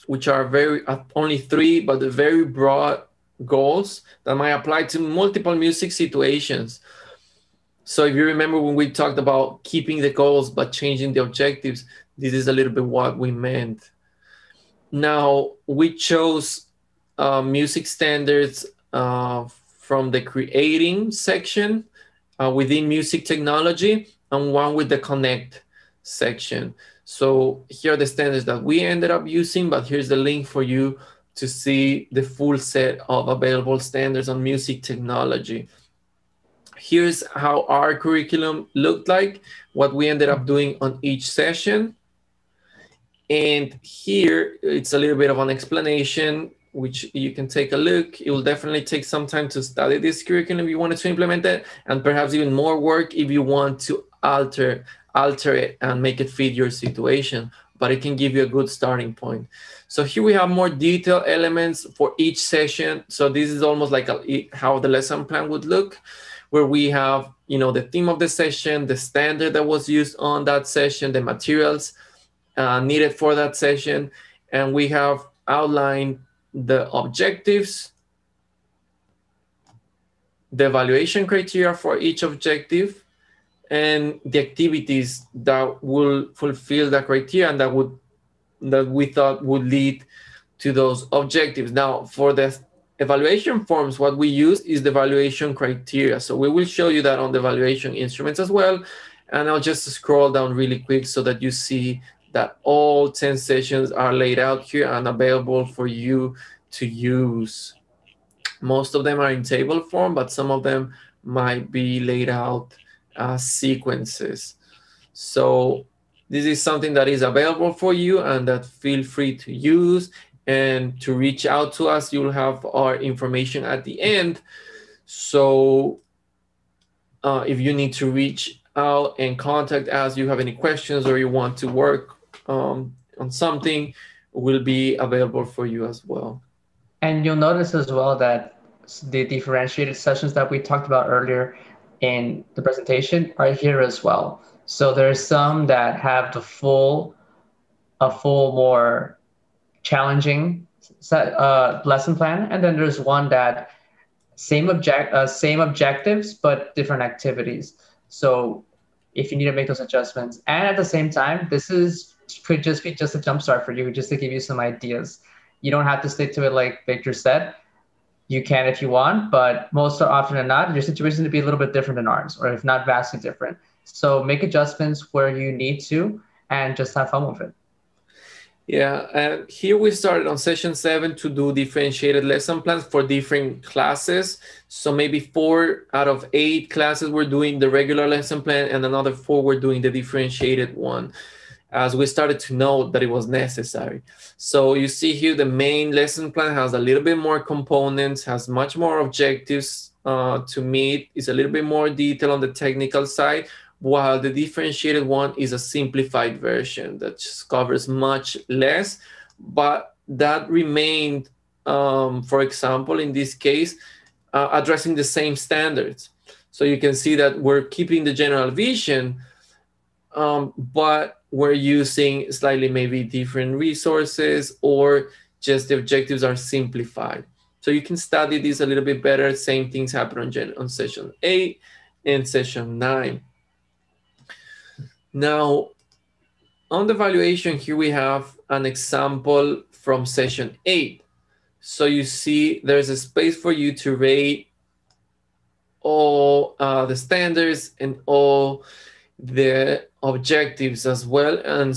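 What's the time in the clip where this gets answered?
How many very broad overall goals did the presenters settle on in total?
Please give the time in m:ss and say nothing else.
0:01.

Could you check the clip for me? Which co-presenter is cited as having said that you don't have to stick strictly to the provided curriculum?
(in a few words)
Victor.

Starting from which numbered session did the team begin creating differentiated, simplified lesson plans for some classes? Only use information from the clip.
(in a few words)
7.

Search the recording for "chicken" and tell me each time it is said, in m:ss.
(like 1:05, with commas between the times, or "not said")
not said.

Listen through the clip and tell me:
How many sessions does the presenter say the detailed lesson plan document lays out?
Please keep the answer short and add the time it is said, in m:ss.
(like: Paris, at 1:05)
10, at 1:43.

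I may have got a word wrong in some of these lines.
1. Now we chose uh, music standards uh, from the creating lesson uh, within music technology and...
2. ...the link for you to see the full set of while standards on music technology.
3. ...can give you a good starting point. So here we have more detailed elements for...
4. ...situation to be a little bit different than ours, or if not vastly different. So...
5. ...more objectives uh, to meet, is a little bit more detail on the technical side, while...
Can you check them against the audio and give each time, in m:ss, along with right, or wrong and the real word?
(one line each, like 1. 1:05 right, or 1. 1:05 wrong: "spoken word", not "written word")
1. 0:14 wrong: "section", not "lesson"
2. 0:30 wrong: "available", not "while"
3. 0:58 right
4. 2:50 right
5. 3:18 right.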